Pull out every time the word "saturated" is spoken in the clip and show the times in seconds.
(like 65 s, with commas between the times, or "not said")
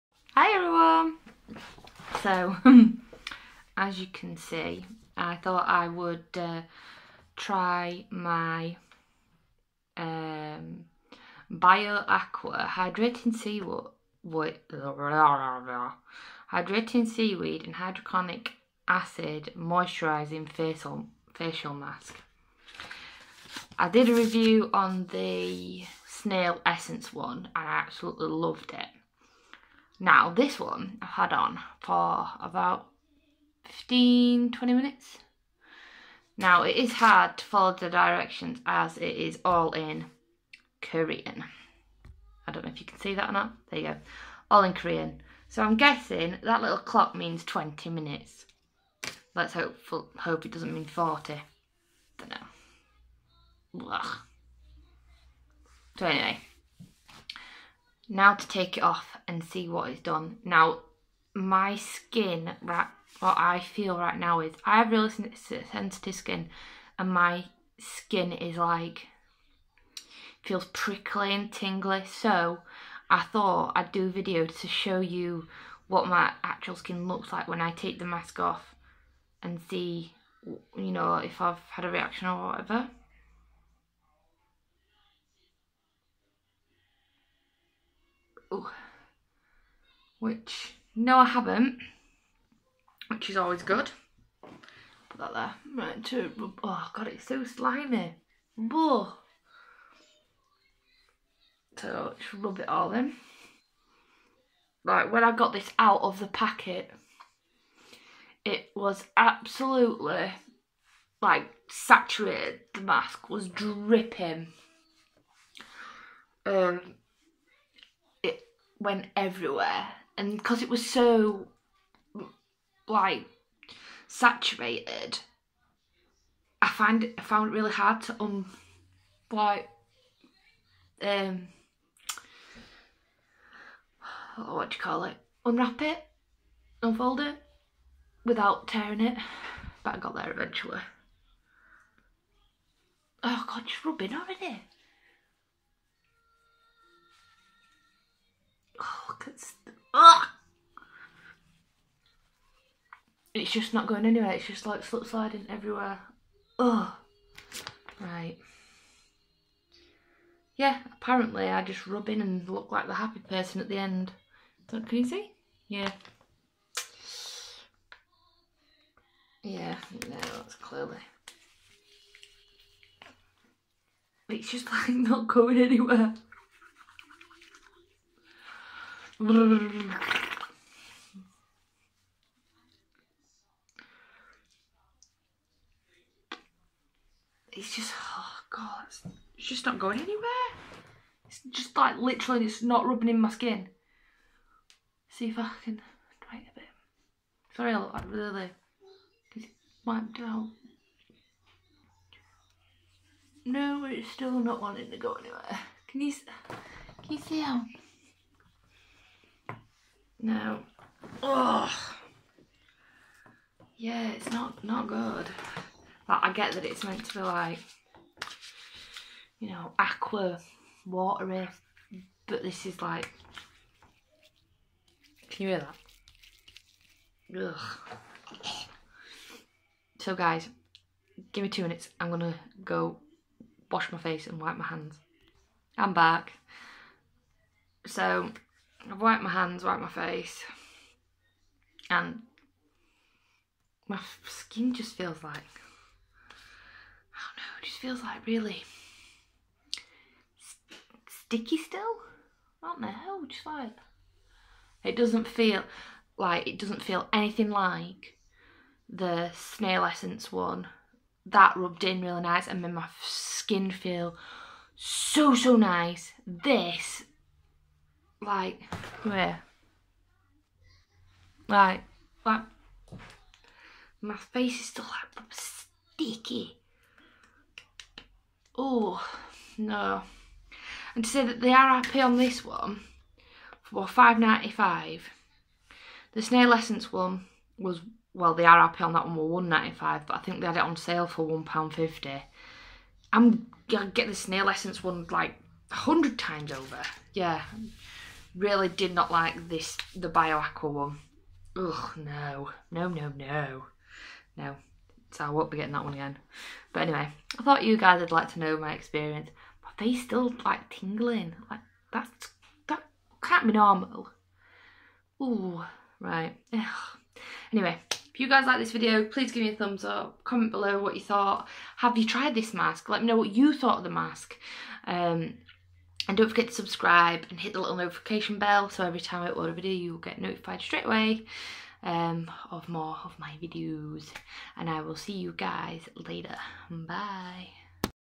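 111 s, 124 s.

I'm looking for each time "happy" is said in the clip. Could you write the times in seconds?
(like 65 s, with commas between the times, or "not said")
162 s, 281 s, 288 s.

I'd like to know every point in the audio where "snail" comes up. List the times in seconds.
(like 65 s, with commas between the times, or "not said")
26 s, 259 s, 286 s, 294 s.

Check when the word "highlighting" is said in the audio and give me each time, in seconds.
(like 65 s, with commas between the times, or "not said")
not said.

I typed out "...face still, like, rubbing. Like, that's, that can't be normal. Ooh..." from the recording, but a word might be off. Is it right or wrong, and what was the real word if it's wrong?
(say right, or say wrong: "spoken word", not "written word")
wrong: "tingling", not "rubbing".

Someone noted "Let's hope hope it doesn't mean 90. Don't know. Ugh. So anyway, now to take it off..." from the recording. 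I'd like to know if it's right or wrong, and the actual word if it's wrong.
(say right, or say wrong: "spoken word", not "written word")
wrong: "40", not "90".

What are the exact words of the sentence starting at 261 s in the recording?
That rubbed in really nice and made my skin feel so, so nice.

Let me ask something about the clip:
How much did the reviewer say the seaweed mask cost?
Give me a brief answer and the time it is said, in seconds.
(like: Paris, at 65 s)
5.95, at 283 s.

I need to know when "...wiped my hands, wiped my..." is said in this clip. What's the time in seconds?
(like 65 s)
239 s.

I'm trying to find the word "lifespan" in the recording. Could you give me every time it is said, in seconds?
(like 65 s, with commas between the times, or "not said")
not said.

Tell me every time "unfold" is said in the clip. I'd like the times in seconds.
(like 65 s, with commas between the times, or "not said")
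136 s.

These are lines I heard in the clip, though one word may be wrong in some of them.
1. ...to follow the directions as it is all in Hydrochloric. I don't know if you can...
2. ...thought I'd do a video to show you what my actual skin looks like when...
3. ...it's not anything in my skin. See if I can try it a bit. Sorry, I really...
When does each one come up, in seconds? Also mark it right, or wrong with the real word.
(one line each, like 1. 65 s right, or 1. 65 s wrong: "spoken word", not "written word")
1. 37 s wrong: "Korean", not "Hydrochloric"
2. 73 s right
3. 192 s wrong: "rubbing", not "anything".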